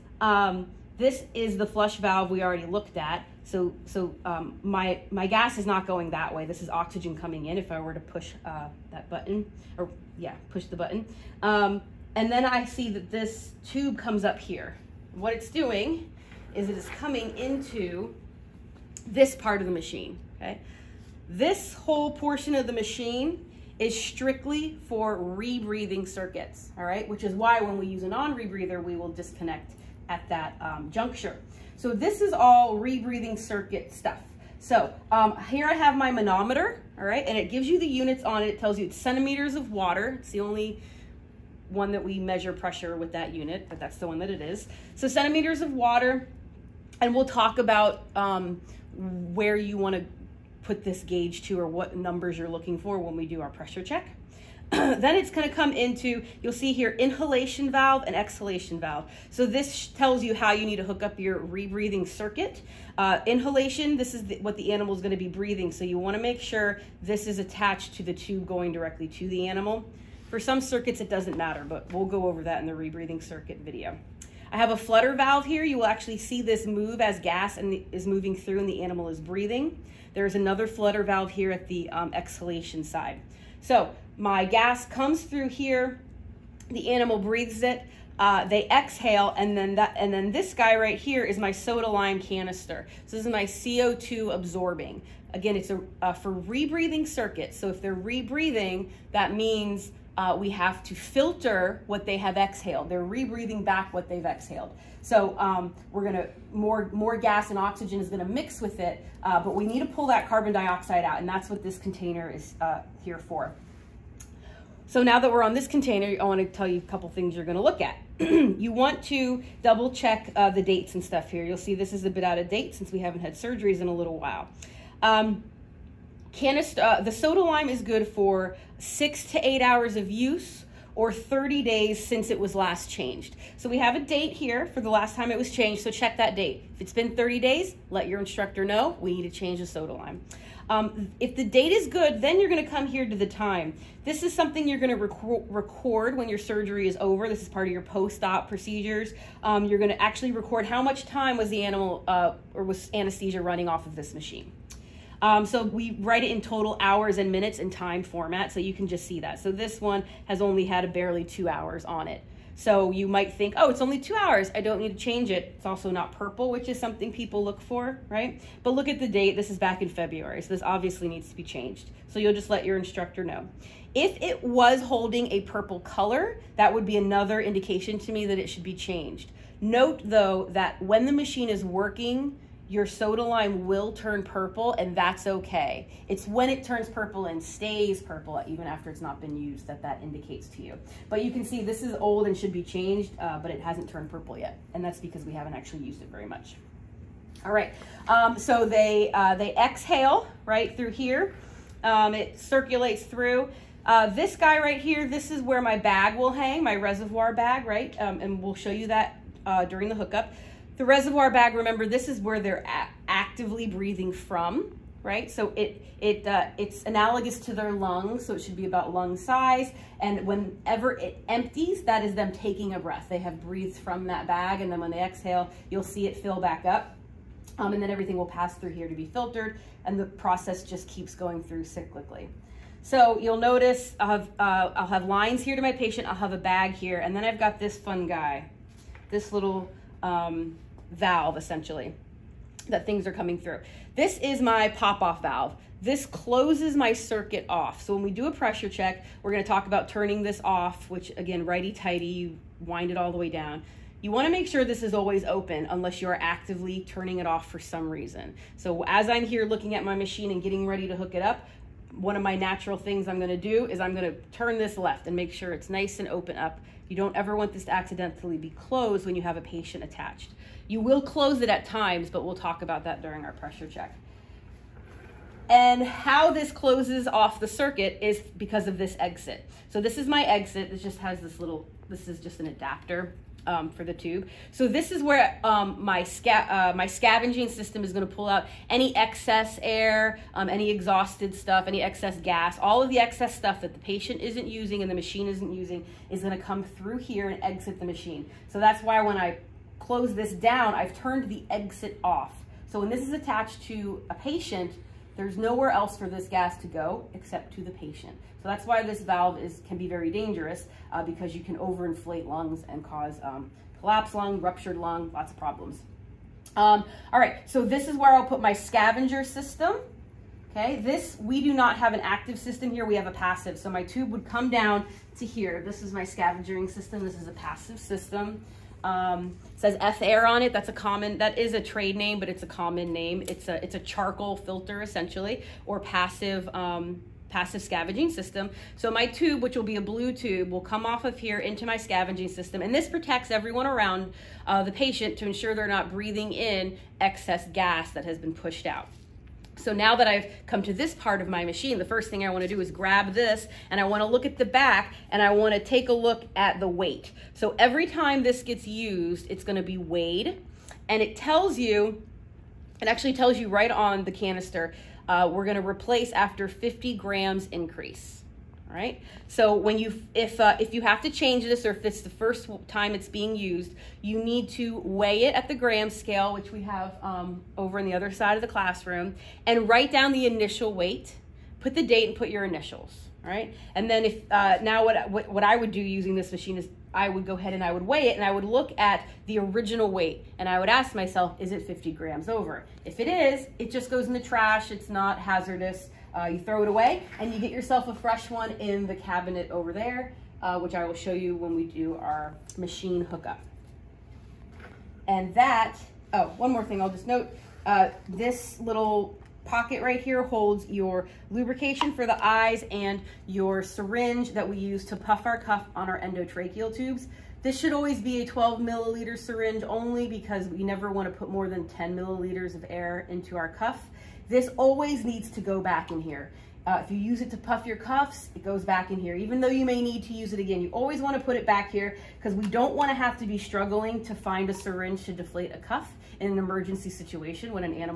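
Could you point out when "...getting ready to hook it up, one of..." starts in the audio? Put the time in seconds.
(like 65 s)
260 s.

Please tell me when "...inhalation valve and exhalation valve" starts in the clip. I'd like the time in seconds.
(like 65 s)
56 s.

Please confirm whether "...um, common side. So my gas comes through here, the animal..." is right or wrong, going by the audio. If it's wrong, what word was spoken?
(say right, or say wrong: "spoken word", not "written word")
wrong: "exhalation", not "common".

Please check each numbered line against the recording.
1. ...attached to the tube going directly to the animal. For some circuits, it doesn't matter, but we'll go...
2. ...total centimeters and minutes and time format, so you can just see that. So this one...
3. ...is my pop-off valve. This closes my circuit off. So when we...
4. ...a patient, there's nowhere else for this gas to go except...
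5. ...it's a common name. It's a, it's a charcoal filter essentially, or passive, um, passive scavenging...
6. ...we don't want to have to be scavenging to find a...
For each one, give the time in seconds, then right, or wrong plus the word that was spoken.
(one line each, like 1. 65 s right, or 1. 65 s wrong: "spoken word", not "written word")
1. 67 s right
2. 156 s wrong: "hours", not "centimeters"
3. 244 s right
4. 304 s right
5. 332 s right
6. 432 s wrong: "struggling", not "scavenging".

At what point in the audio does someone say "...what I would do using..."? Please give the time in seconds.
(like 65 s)
385 s.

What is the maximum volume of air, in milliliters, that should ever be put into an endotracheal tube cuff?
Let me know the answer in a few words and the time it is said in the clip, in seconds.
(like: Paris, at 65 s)
10 milliliters, at 421 s.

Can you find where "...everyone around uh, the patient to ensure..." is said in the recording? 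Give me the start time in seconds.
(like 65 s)
343 s.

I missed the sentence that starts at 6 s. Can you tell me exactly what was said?
This is oxygen coming in if I were to push uh, that button, or yeah, push the button.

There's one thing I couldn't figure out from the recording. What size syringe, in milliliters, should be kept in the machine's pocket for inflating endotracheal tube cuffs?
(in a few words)
12 milliliters.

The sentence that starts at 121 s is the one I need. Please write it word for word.
You'll see this is a bit out of date since we haven't had surgeries in a little while.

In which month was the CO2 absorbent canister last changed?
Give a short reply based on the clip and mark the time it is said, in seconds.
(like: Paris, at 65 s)
February, at 169 s.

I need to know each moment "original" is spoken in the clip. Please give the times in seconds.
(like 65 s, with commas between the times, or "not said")
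389 s.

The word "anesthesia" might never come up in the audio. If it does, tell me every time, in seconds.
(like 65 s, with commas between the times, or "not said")
152 s.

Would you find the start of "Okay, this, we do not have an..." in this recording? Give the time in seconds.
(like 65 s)
320 s.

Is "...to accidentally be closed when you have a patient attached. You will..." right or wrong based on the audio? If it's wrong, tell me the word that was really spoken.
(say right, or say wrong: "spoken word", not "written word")
right.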